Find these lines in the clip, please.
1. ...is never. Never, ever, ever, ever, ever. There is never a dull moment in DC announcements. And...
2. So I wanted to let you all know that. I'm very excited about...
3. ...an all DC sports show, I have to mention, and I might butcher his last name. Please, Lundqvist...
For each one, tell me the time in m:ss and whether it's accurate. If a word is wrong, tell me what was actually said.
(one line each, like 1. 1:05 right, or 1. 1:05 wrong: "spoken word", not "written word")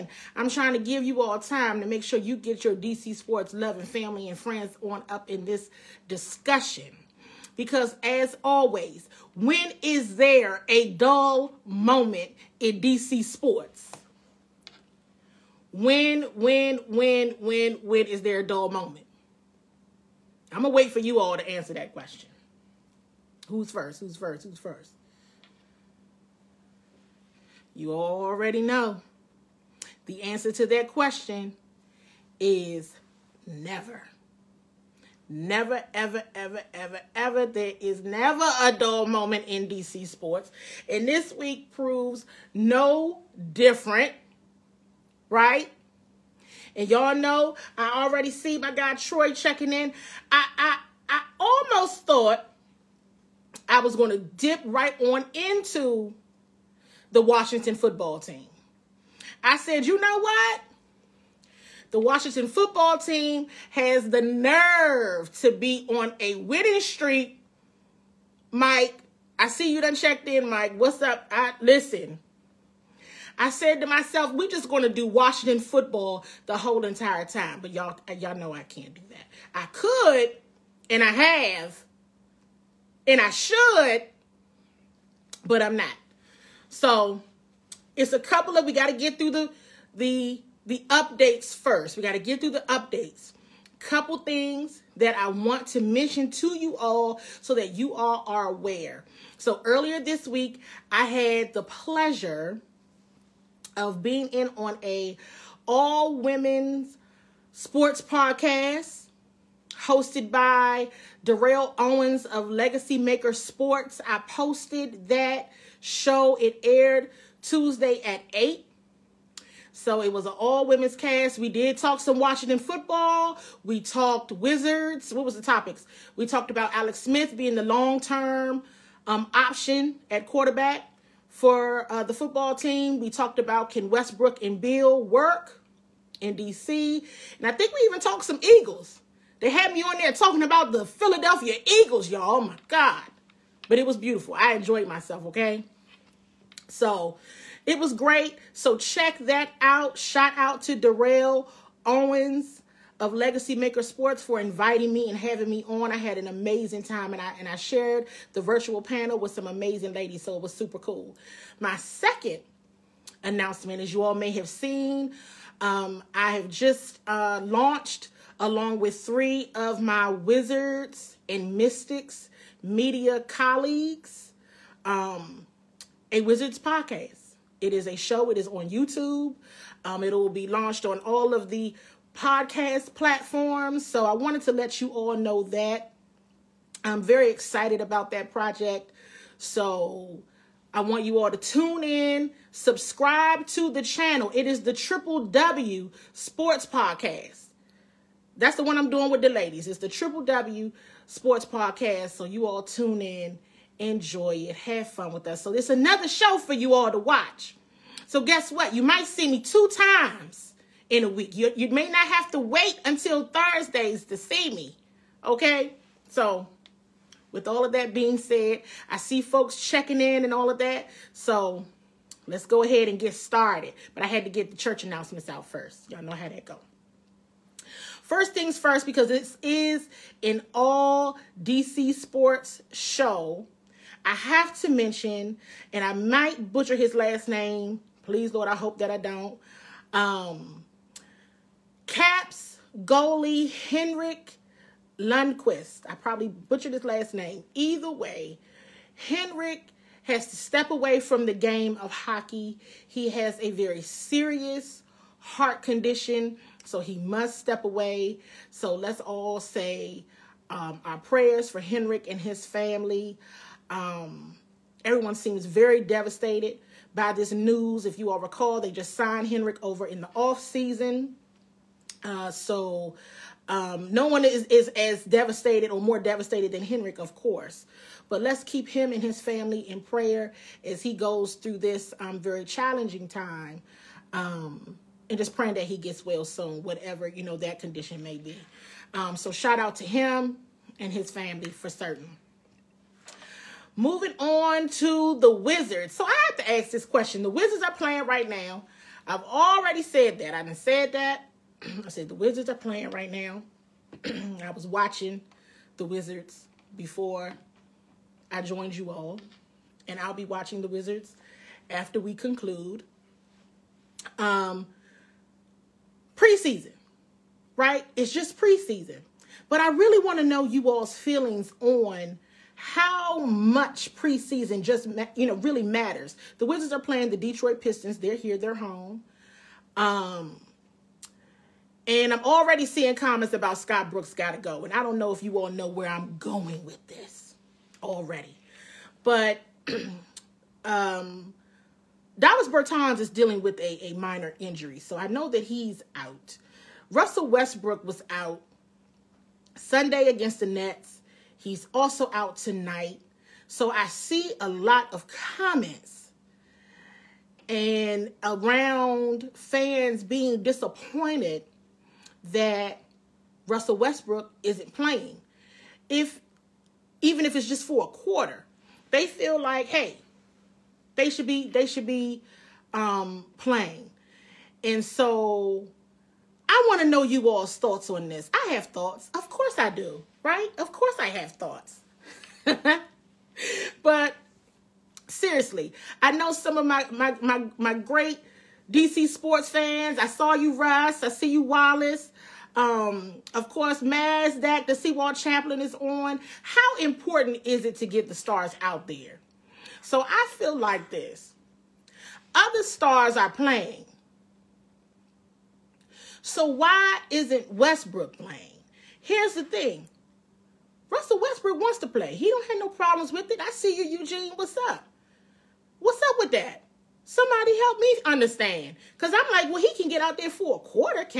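1. 0:32 wrong: "sports", not "announcements"
2. 3:03 right
3. 3:50 wrong: "Lord", not "Lundqvist".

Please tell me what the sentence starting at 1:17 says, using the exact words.
But y'all, uh, y'all know I can't do that.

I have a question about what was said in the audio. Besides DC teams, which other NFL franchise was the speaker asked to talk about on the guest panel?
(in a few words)
Philadelphia Eagles.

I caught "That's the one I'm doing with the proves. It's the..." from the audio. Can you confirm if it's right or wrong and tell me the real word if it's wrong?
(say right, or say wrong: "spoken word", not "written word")
wrong: "ladies", not "proves".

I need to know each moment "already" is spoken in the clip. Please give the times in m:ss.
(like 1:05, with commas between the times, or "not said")
0:27, 0:48, 4:59, 5:32, 5:37.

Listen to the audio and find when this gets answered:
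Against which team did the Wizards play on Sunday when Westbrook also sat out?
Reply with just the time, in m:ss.
5:50.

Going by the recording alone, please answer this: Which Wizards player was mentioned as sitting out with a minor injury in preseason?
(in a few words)
Davis Bertans.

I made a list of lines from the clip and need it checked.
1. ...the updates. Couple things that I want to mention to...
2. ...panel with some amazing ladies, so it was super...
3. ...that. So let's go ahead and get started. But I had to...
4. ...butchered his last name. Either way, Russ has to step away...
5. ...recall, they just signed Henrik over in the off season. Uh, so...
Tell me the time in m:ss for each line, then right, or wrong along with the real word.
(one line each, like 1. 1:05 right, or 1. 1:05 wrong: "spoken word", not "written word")
1. 1:32 right
2. 2:38 right
3. 3:40 right
4. 4:06 wrong: "Henrik", not "Russ"
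5. 4:28 right.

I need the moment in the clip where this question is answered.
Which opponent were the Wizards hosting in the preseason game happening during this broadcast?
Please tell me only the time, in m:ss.
5:27.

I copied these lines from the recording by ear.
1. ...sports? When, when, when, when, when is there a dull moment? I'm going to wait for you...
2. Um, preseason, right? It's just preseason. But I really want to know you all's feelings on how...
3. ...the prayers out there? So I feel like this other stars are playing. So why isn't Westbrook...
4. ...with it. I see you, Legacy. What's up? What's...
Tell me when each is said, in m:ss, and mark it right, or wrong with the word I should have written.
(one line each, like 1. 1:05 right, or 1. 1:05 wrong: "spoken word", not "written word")
1. 0:13 right
2. 5:14 right
3. 6:38 wrong: "stars", not "prayers"
4. 6:53 wrong: "Eugene", not "Legacy".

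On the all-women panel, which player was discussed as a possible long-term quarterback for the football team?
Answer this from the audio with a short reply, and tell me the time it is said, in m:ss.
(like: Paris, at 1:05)
Alex Smith, at 2:06.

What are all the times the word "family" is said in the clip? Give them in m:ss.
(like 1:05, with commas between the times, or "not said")
0:03, 4:22, 4:39, 4:51.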